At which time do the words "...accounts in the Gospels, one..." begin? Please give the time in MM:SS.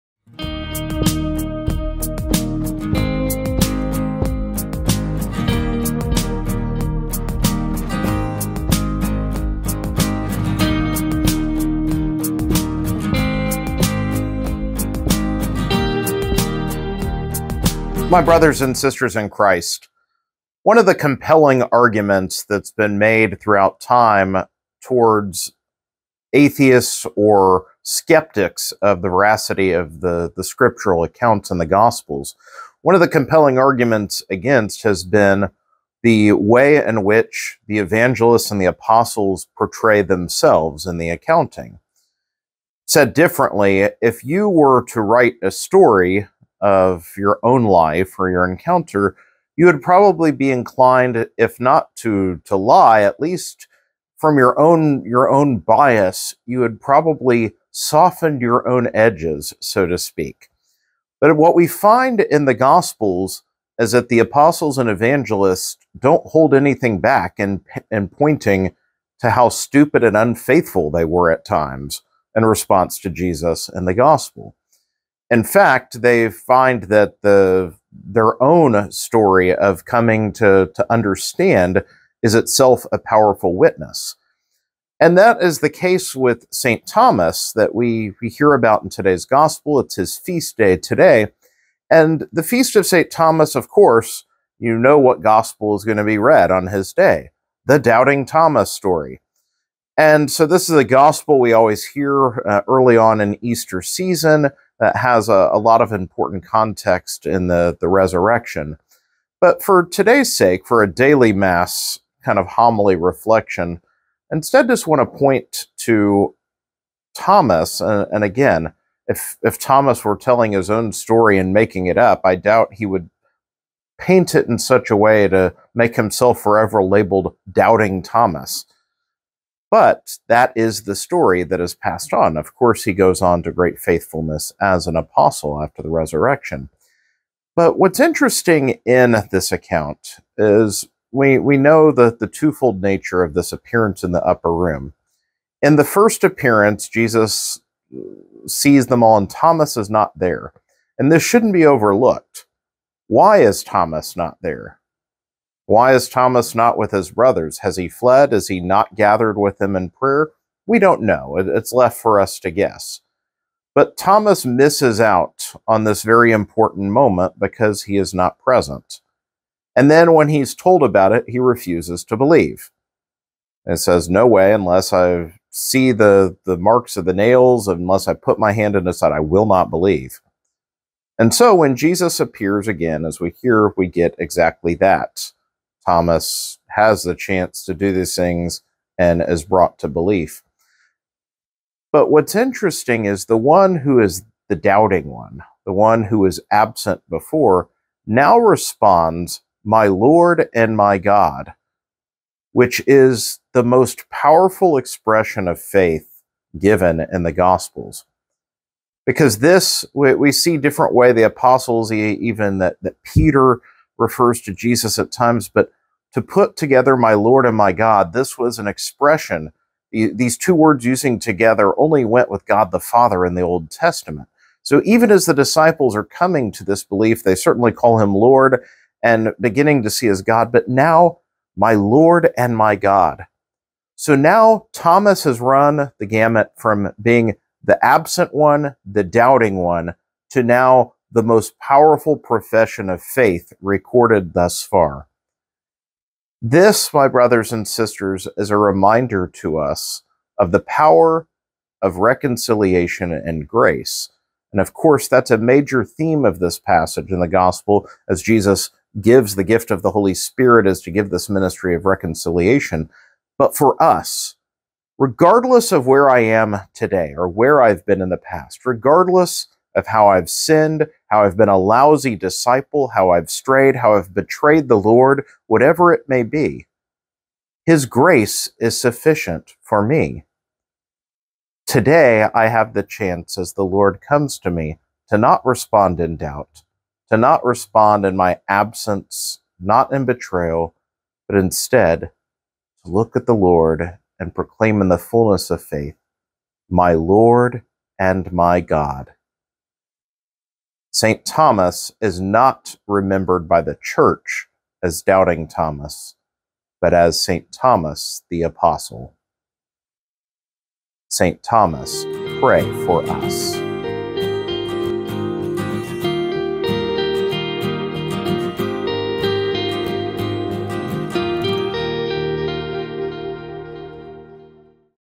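00:31.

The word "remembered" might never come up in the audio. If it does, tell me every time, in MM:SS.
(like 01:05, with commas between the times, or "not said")
05:02.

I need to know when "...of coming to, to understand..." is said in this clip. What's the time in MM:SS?
01:19.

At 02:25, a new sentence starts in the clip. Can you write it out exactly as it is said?
In the first appearance, Jesus sees them all, and Thomas is not there.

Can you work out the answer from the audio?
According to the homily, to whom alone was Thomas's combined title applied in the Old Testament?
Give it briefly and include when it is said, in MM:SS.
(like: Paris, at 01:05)
God the Father, at 03:42.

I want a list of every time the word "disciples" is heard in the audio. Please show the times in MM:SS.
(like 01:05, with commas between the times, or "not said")
03:45, 04:32.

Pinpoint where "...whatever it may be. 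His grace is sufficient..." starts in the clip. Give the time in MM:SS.
04:35.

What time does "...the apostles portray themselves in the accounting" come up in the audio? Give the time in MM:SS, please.
00:38.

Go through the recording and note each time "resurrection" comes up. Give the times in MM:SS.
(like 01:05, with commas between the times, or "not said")
01:47, 02:15.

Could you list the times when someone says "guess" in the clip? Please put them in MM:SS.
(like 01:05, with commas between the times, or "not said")
02:42.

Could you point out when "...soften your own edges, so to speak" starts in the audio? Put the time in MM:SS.
00:57.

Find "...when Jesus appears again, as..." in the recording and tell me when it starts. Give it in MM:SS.
03:01.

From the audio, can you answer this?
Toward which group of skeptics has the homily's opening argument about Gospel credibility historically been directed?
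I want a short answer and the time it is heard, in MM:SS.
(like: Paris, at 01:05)
atheists, at 00:26.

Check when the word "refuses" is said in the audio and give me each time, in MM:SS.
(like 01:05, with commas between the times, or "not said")
02:51.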